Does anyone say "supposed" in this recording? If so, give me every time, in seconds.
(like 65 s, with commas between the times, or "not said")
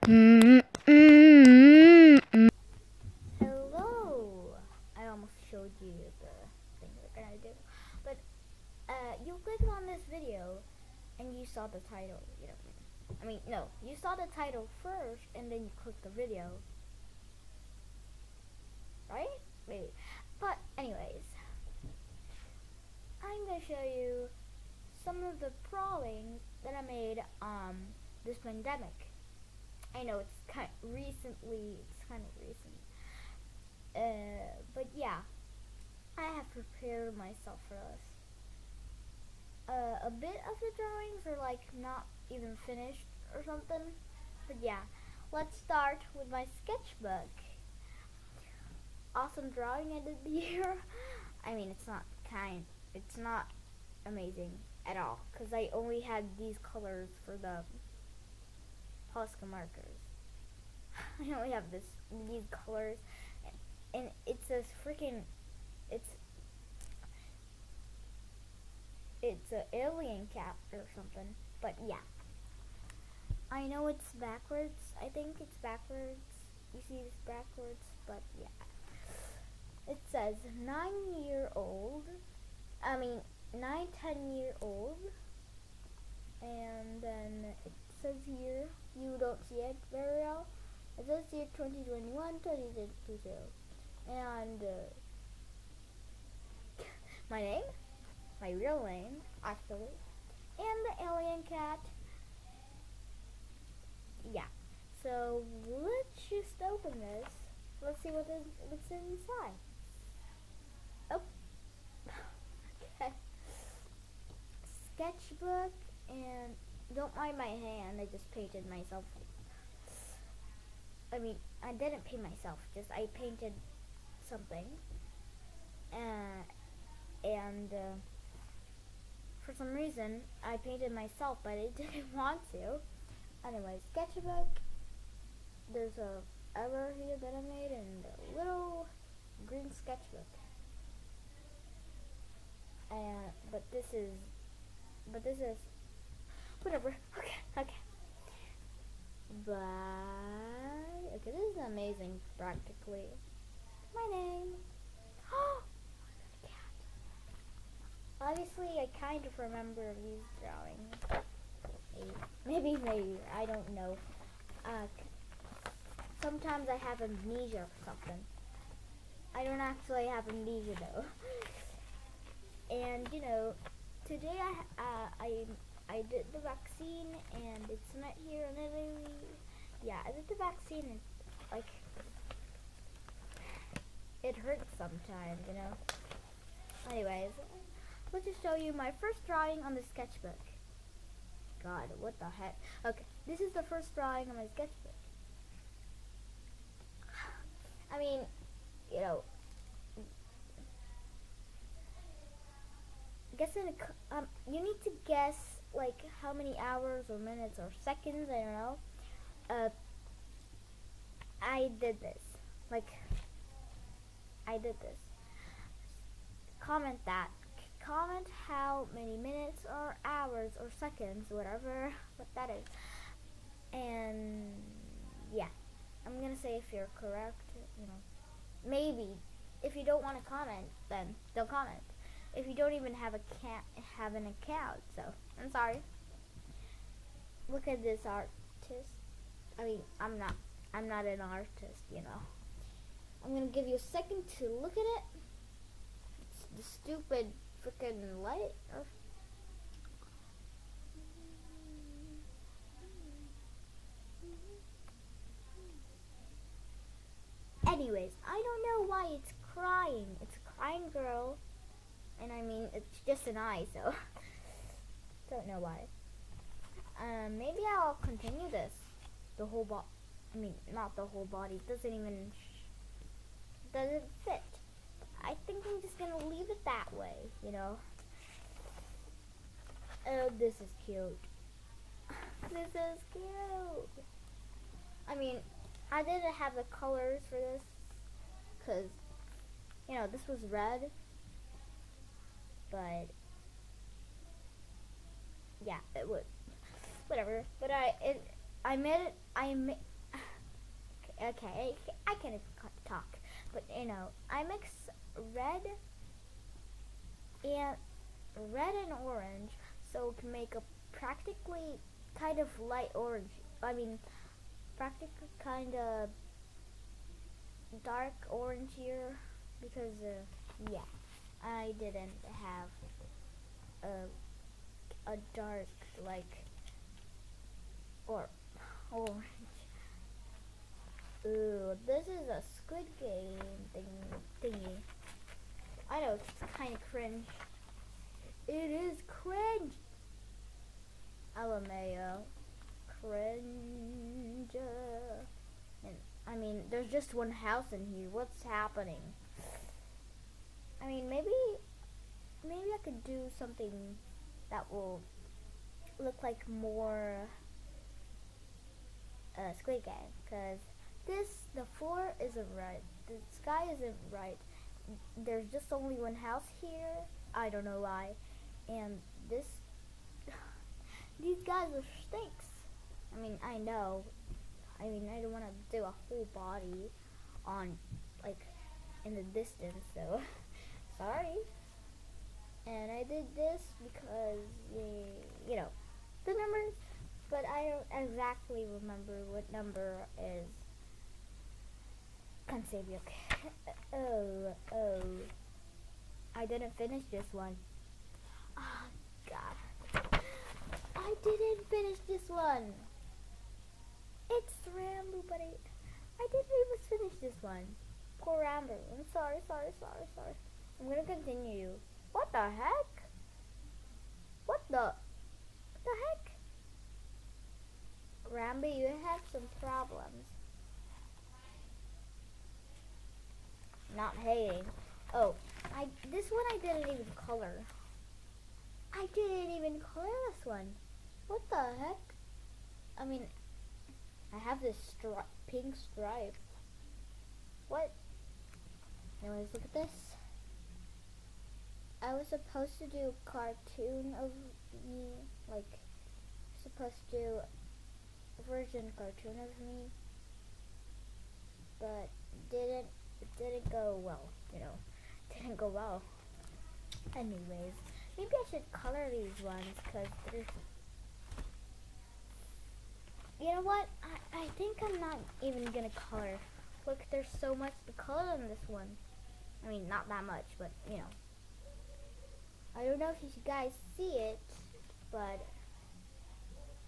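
442 s, 446 s.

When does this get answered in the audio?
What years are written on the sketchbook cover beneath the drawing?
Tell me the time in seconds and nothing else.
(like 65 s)
91 s.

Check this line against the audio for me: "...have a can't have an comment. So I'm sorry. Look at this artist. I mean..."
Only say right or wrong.
wrong.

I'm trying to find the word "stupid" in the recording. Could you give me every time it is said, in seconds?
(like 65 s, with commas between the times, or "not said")
246 s.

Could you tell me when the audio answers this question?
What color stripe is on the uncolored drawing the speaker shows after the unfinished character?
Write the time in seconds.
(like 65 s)
435 s.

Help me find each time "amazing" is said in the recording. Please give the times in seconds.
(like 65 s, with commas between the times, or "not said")
54 s, 151 s.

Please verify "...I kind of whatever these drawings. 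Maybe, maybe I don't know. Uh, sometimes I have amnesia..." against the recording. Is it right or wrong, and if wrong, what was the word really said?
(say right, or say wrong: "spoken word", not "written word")
wrong: "remember", not "whatever".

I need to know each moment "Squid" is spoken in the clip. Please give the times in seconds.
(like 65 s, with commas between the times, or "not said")
332 s, 359 s.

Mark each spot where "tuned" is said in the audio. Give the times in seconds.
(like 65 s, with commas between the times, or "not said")
not said.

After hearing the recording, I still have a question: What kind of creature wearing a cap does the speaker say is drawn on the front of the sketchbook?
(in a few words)
alien cat.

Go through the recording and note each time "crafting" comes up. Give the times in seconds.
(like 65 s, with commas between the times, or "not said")
not said.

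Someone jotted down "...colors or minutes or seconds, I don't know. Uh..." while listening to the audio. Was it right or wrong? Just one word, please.
wrong.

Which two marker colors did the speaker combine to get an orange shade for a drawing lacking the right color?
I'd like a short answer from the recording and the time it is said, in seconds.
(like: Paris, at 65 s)
red and orange, at 308 s.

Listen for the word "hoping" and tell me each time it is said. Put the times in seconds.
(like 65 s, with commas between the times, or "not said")
not said.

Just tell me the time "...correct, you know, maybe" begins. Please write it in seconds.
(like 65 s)
226 s.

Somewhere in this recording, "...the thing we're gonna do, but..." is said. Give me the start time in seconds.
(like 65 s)
6 s.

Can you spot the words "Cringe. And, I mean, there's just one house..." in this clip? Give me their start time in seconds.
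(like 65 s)
342 s.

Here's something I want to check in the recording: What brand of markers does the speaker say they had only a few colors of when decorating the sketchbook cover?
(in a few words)
Posca.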